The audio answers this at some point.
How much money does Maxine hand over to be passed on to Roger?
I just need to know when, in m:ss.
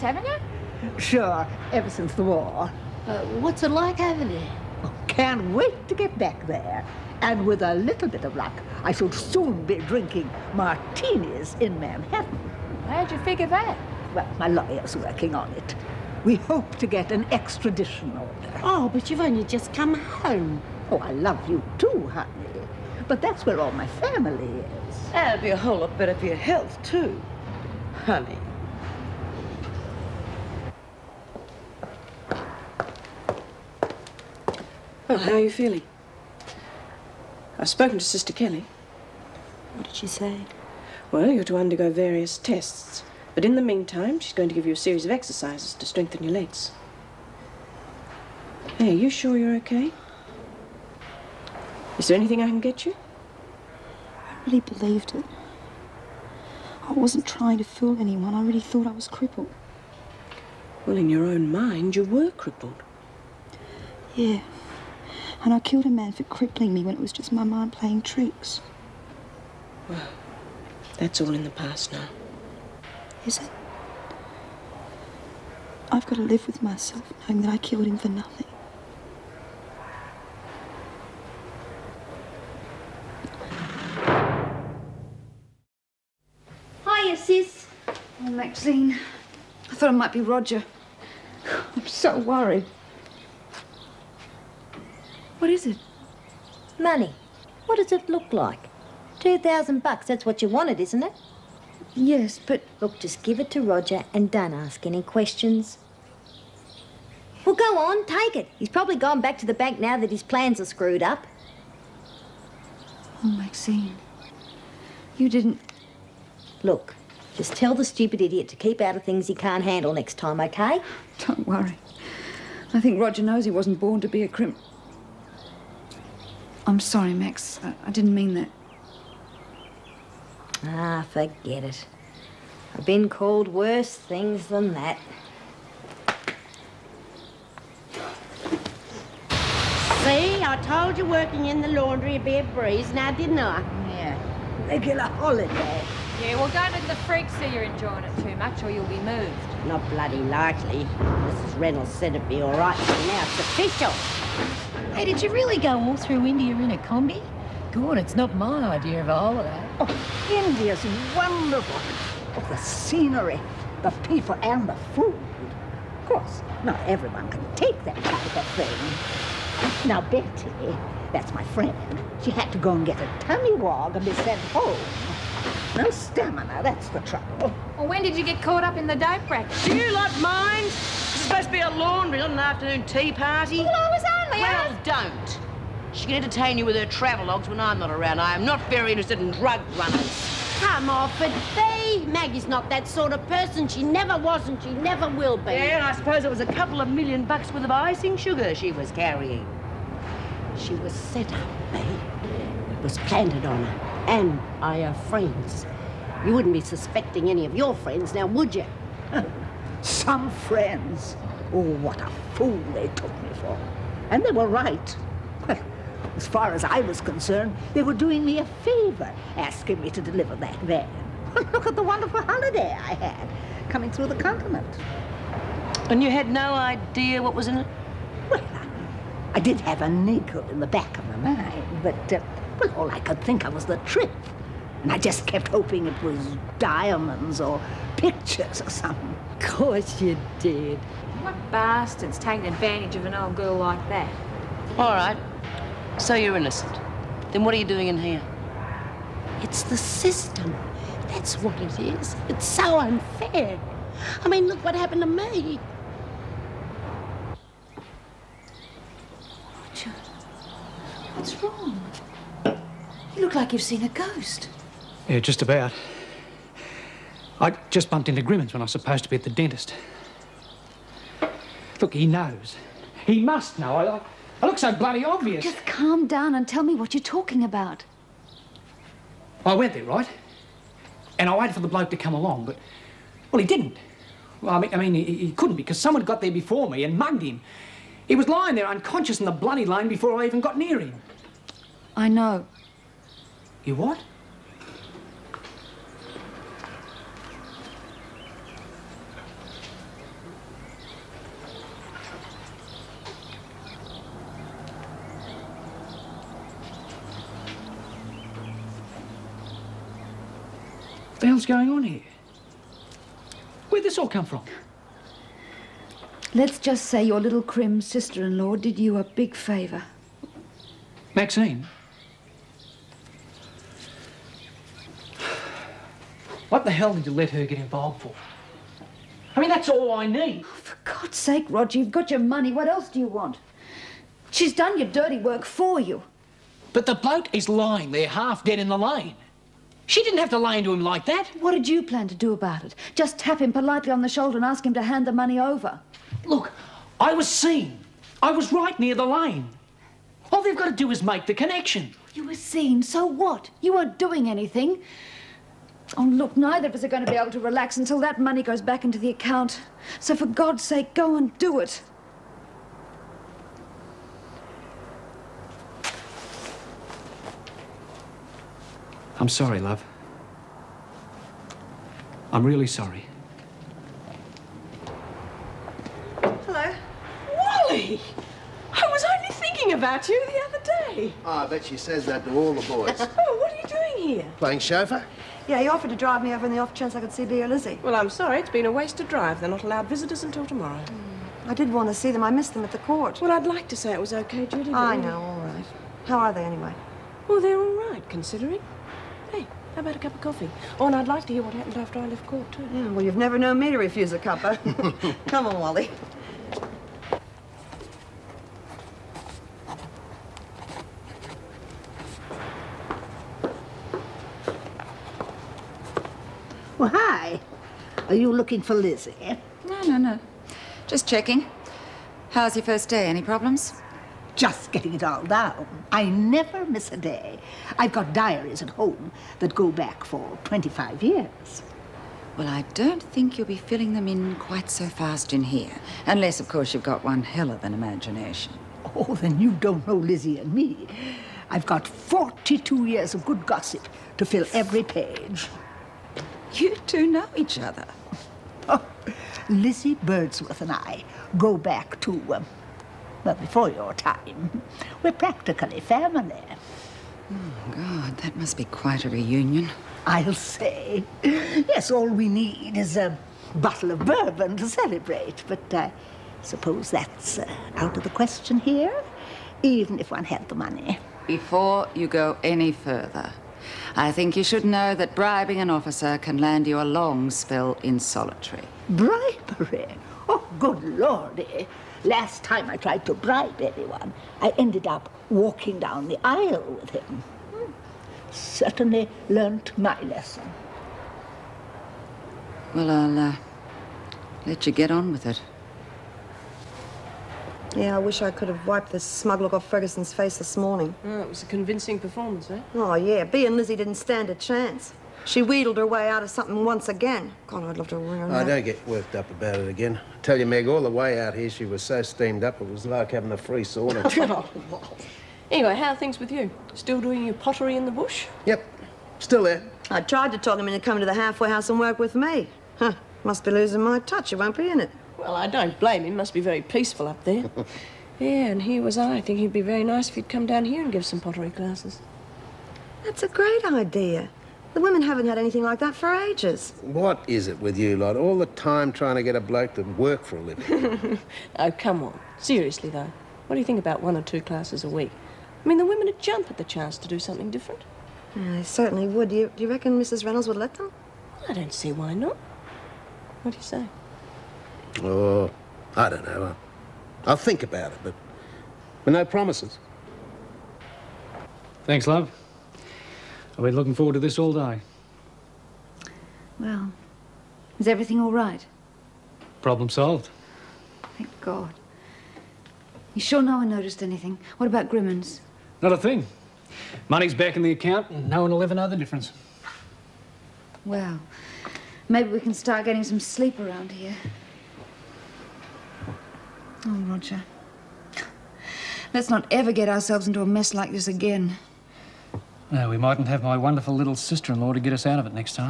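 1:39.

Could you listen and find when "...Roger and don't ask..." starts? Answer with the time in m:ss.
1:43.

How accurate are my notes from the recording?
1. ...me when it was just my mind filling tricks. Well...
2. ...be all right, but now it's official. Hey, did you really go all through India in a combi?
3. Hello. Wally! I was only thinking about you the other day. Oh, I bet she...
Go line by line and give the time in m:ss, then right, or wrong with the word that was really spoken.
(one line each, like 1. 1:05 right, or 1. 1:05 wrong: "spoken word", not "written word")
1. 1:06 wrong: "playing", not "filling"
2. 2:32 right
3. 6:16 right.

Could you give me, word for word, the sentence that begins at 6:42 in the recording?
Yeah, well, you've never known me to refuse a cuppa.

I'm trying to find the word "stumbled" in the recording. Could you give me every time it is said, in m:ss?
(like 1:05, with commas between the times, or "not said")
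not said.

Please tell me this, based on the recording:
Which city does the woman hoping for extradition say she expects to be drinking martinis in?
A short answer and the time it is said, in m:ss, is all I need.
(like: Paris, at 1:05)
Manhattan, at 0:11.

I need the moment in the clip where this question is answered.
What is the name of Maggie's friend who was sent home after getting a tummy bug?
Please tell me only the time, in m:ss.
2:50.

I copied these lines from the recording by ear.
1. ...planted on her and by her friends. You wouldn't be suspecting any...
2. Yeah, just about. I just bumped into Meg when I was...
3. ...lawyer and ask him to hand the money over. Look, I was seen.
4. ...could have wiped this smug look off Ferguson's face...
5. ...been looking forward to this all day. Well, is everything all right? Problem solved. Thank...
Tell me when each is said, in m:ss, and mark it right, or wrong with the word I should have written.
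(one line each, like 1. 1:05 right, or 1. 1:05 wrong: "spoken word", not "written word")
1. 3:22 right
2. 4:25 wrong: "Grimmins", not "Meg"
3. 5:44 wrong: "shoulder", not "lawyer"
4. 8:18 right
5. 9:23 right.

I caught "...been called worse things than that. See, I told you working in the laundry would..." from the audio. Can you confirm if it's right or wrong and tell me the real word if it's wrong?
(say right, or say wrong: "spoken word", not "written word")
right.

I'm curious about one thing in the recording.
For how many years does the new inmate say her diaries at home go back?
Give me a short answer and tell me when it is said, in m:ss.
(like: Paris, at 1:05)
25, at 7:10.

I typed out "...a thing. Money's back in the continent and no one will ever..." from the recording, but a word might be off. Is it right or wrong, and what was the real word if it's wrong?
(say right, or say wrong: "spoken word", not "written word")
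wrong: "account", not "continent".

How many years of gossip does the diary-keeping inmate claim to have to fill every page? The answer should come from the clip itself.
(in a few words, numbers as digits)
42.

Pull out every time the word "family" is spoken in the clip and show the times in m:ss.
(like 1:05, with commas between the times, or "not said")
0:23, 7:35.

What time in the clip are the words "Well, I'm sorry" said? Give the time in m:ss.
6:27.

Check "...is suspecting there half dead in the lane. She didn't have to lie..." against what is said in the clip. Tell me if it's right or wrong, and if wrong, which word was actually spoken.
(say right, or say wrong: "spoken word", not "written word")
wrong: "lying", not "suspecting".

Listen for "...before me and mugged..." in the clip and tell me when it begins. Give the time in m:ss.
4:46.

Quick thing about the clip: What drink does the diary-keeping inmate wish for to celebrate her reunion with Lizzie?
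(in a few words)
Bourbon.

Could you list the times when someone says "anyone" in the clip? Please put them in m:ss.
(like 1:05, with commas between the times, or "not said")
0:57, 8:03.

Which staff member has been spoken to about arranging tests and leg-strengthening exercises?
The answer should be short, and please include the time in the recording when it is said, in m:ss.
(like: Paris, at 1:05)
Sister Kelly, at 0:38.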